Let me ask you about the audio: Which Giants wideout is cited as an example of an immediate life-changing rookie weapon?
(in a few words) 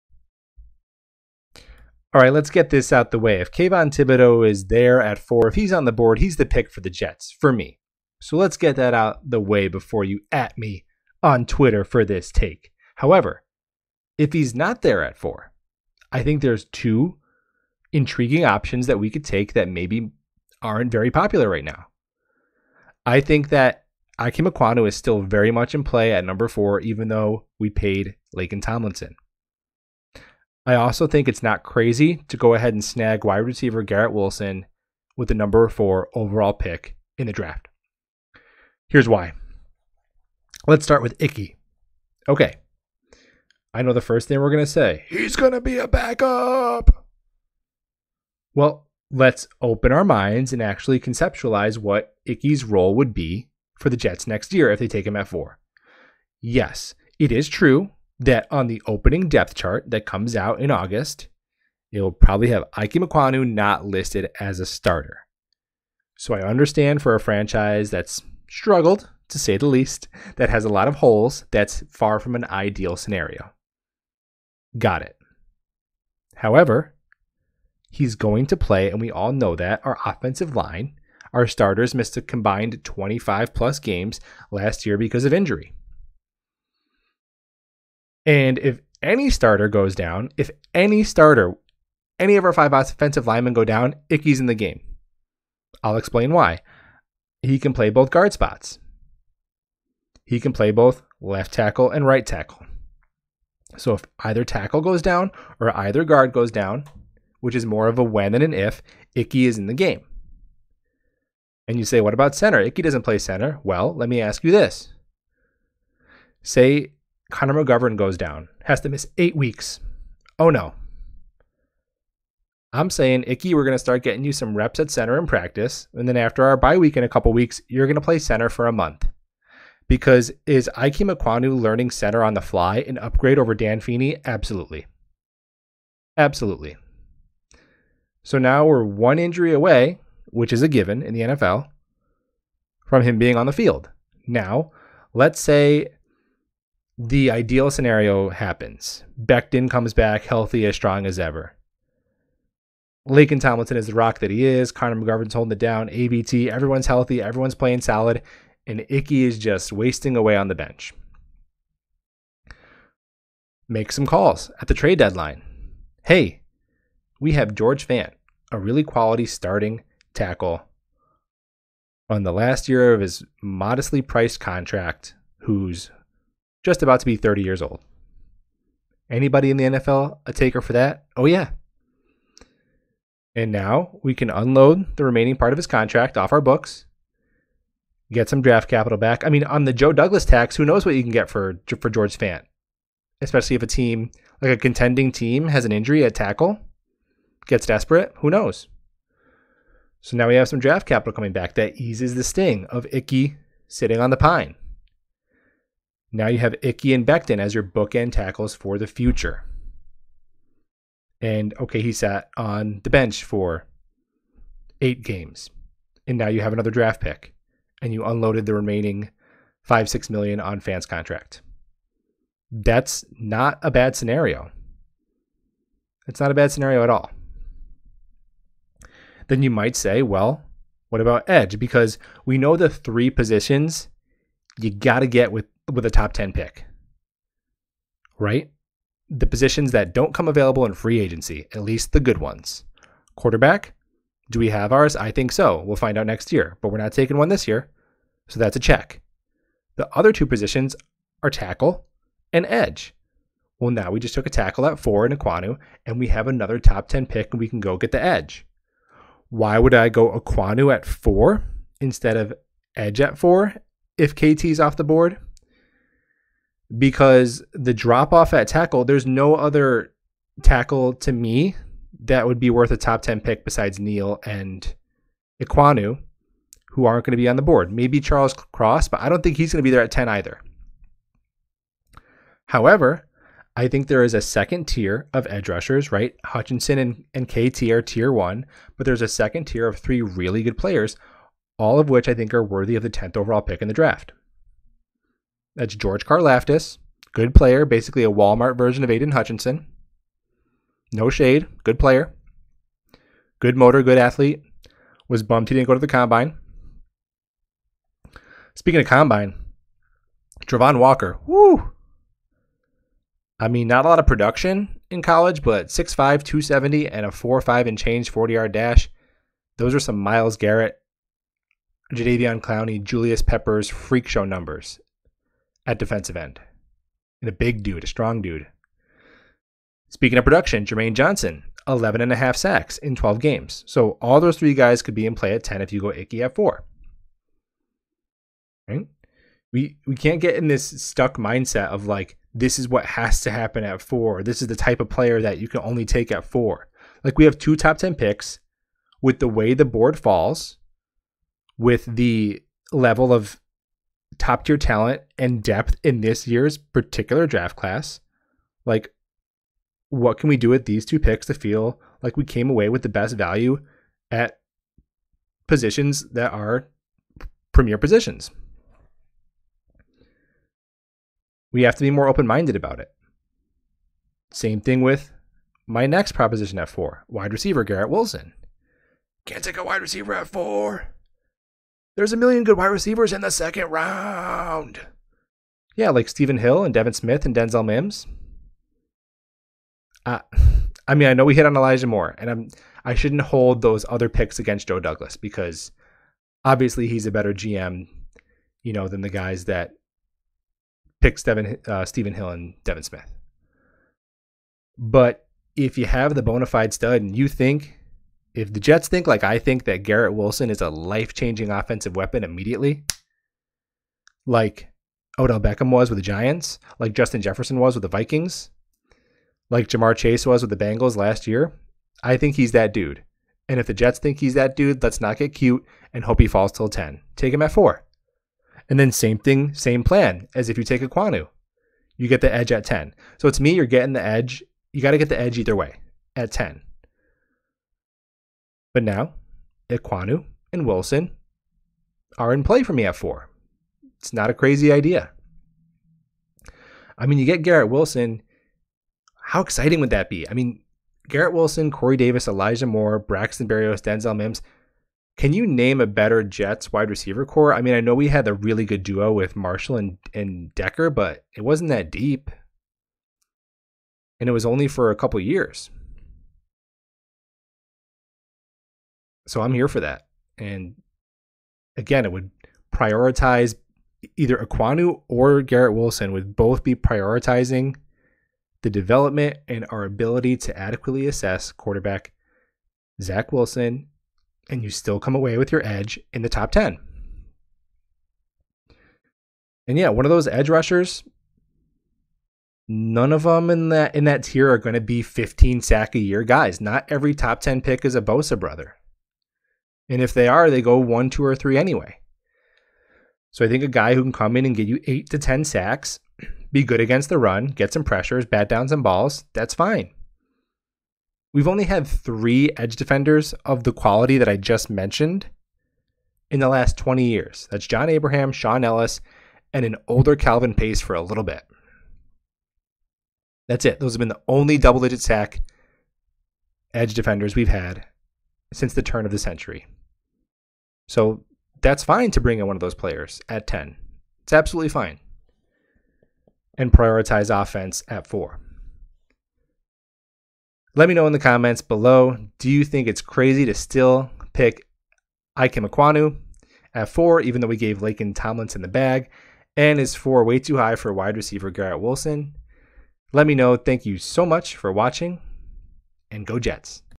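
Odell Beckham.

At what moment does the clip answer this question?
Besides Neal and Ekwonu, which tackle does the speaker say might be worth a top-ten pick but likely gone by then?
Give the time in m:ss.
4:37.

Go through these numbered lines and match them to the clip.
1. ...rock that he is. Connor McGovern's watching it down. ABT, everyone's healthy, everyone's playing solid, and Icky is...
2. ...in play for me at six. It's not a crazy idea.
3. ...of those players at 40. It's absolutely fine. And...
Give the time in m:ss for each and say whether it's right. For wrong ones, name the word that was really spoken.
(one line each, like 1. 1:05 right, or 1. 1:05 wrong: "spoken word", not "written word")
1. 2:33 wrong: "holding", not "watching"
2. 7:22 wrong: "four", not "six"
3. 8:52 wrong: "10", not "40".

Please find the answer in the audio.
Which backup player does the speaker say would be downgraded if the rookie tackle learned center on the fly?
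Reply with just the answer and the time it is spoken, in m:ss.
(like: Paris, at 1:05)
Dan Feeney, at 2:13.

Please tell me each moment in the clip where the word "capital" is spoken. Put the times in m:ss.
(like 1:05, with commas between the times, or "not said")
3:08, 3:20.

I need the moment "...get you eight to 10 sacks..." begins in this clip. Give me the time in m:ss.
8:24.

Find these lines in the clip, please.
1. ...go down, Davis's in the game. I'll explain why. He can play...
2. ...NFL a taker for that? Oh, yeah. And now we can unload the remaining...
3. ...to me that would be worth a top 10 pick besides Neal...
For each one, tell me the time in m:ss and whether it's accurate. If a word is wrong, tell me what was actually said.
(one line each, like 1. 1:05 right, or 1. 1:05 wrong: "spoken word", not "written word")
1. 1:33 wrong: "Icky", not "Davis"
2. 2:59 right
3. 4:30 right.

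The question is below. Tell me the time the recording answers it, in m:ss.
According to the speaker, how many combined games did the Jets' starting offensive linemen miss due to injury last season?
1:22.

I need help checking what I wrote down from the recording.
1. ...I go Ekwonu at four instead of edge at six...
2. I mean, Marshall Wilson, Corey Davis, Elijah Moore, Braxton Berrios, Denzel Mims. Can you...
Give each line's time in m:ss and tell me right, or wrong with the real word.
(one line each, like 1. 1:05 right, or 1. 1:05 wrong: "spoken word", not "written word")
1. 4:19 wrong: "four", not "six"
2. 7:30 wrong: "Garrett", not "Marshall".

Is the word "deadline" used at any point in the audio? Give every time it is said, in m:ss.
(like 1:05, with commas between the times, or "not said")
2:44.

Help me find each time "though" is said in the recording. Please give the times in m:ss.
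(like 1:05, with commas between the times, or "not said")
0:27, 9:07.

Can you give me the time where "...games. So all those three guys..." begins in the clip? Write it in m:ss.
5:33.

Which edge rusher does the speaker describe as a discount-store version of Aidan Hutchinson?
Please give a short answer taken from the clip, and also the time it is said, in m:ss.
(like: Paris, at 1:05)
George Karlaftis, at 4:55.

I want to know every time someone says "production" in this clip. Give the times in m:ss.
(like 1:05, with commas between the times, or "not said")
5:14, 5:30.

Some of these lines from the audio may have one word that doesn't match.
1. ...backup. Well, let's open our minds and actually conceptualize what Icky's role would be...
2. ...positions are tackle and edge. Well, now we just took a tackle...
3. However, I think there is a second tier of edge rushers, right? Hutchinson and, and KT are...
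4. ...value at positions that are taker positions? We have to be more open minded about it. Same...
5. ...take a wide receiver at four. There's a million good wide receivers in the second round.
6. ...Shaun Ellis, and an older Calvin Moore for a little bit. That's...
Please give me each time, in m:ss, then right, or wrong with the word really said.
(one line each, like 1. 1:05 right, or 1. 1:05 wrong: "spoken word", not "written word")
1. 0:45 right
2. 4:10 right
3. 4:42 right
4. 6:03 wrong: "premier", not "taker"
5. 6:19 right
6. 8:38 wrong: "Pace", not "Moore".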